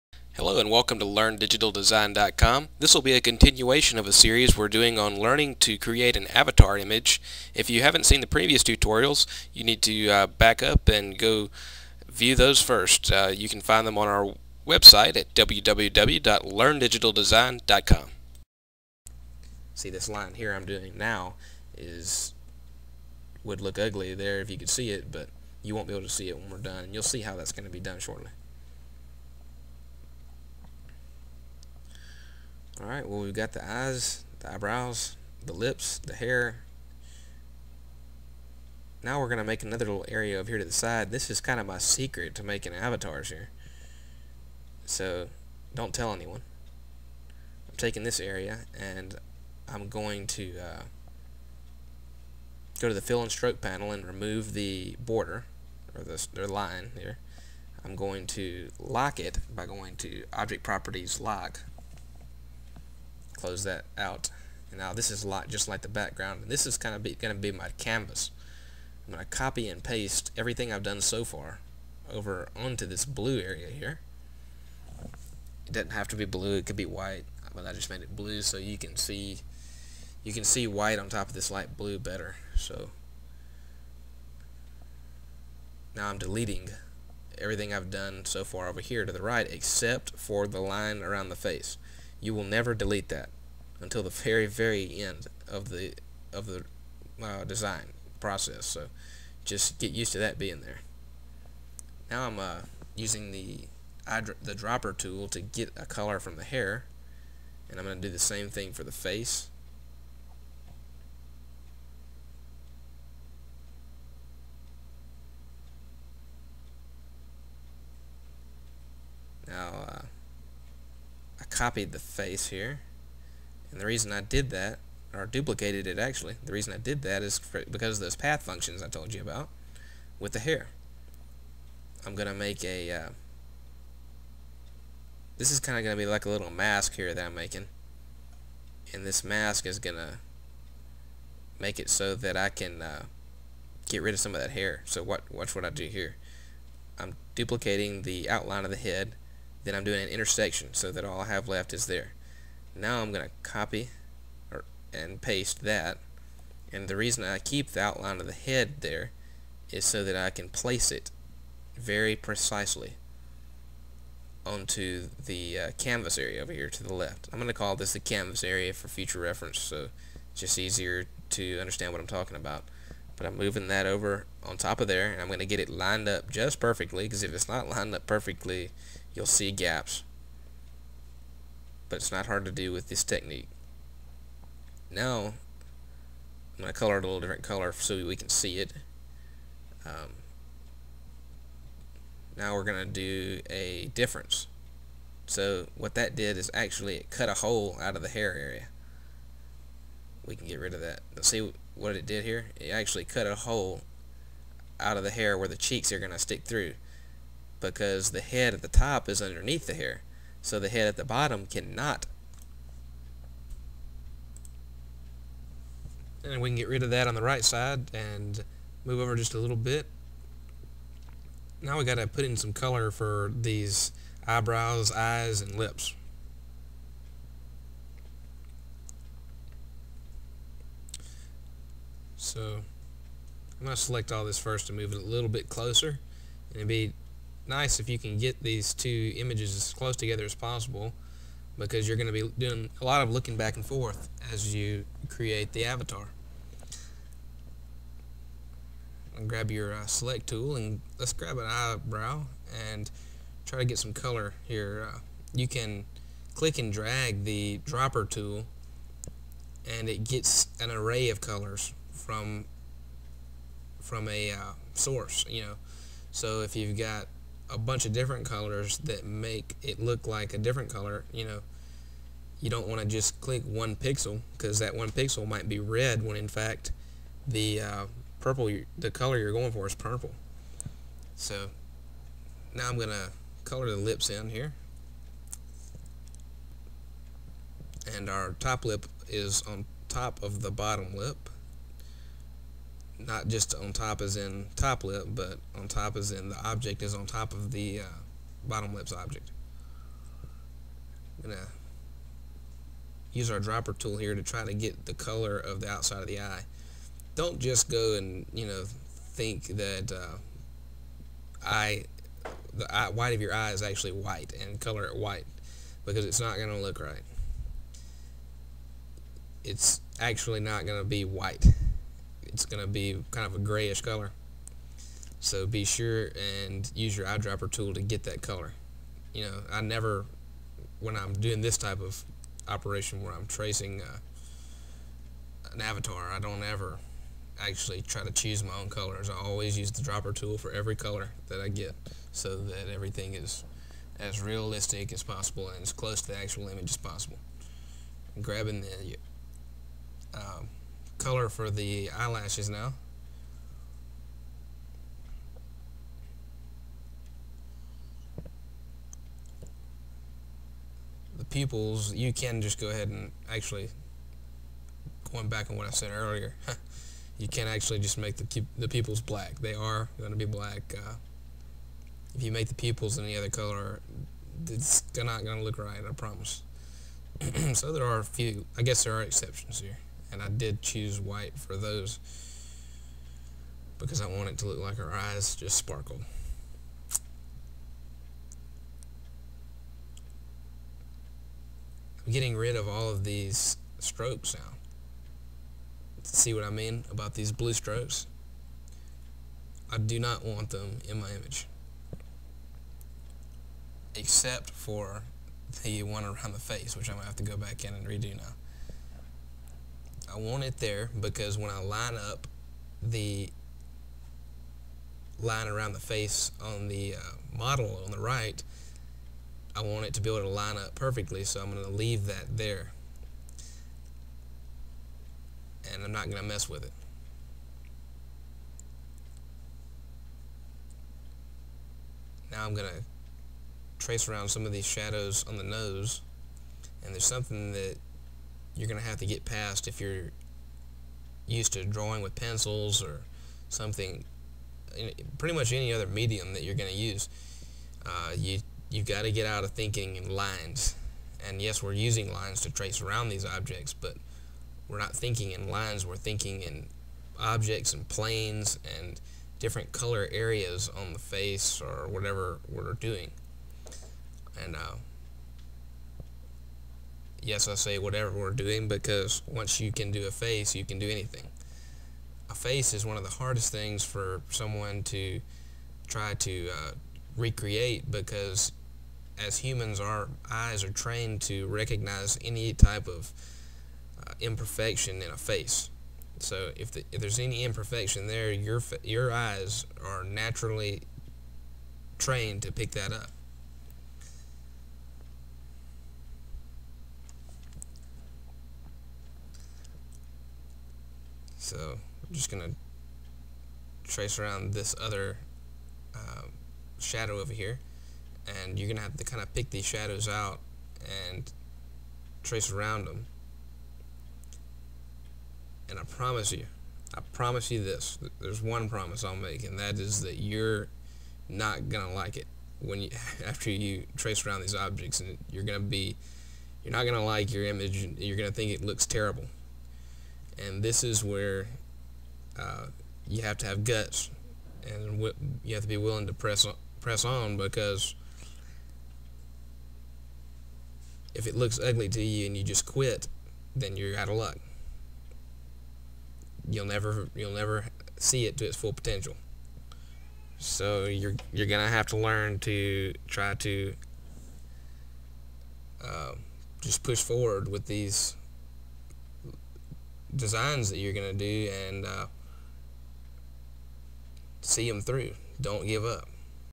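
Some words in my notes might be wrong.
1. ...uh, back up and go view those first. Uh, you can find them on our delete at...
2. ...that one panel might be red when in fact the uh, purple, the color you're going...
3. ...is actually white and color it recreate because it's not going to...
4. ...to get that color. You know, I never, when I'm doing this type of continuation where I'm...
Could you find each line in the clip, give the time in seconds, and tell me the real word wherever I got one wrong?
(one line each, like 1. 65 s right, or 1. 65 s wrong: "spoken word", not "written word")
1. 10 s wrong: "website", not "delete"
2. 274 s wrong: "pixel", not "panel"
3. 313 s wrong: "white", not "recreate"
4. 327 s wrong: "operation", not "continuation".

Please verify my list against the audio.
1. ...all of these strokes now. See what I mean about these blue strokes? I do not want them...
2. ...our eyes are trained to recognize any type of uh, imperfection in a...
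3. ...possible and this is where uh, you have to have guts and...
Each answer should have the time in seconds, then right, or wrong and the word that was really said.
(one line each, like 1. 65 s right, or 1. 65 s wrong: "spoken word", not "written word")
1. 392 s right
2. 479 s right
3. 528 s wrong: "terrible", not "possible".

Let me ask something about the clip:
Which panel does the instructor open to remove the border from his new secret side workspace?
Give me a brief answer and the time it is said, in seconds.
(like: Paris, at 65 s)
Fill and stroke, at 53 s.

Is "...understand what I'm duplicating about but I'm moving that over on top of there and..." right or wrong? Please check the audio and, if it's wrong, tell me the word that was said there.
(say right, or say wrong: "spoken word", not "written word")
wrong: "talking", not "duplicating".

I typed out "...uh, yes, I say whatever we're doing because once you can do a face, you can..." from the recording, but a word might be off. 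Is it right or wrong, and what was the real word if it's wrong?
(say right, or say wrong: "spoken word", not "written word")
right.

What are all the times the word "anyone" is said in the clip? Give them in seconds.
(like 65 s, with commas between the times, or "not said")
46 s.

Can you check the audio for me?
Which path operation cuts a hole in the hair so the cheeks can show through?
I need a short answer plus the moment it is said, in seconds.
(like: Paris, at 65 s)
Difference, at 193 s.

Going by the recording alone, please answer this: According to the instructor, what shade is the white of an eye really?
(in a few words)
Grayish.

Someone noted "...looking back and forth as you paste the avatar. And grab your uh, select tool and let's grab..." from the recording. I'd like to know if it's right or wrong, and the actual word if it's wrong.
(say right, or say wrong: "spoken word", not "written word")
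wrong: "create", not "paste".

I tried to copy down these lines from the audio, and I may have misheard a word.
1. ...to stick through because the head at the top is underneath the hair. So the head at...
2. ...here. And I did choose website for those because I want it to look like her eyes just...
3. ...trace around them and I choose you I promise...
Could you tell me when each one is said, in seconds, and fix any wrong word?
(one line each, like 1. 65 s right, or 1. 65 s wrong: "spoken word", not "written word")
1. 206 s right
2. 379 s wrong: "white", not "website"
3. 512 s wrong: "promise", not "choose".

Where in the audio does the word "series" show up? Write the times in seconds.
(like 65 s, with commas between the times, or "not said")
4 s.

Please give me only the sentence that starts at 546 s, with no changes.
You'll never you'll never see it to its full potential.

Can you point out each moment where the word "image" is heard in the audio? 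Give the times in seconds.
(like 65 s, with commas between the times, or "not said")
6 s, 239 s, 346 s, 401 s, 527 s.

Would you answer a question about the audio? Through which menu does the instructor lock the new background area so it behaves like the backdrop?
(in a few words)
Object properties.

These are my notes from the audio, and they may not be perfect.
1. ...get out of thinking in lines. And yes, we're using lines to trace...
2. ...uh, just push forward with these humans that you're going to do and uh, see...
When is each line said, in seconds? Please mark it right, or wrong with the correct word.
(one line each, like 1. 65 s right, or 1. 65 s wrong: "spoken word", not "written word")
1. 449 s right
2. 555 s wrong: "designs", not "humans".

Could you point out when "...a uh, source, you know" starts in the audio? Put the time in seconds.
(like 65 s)
264 s.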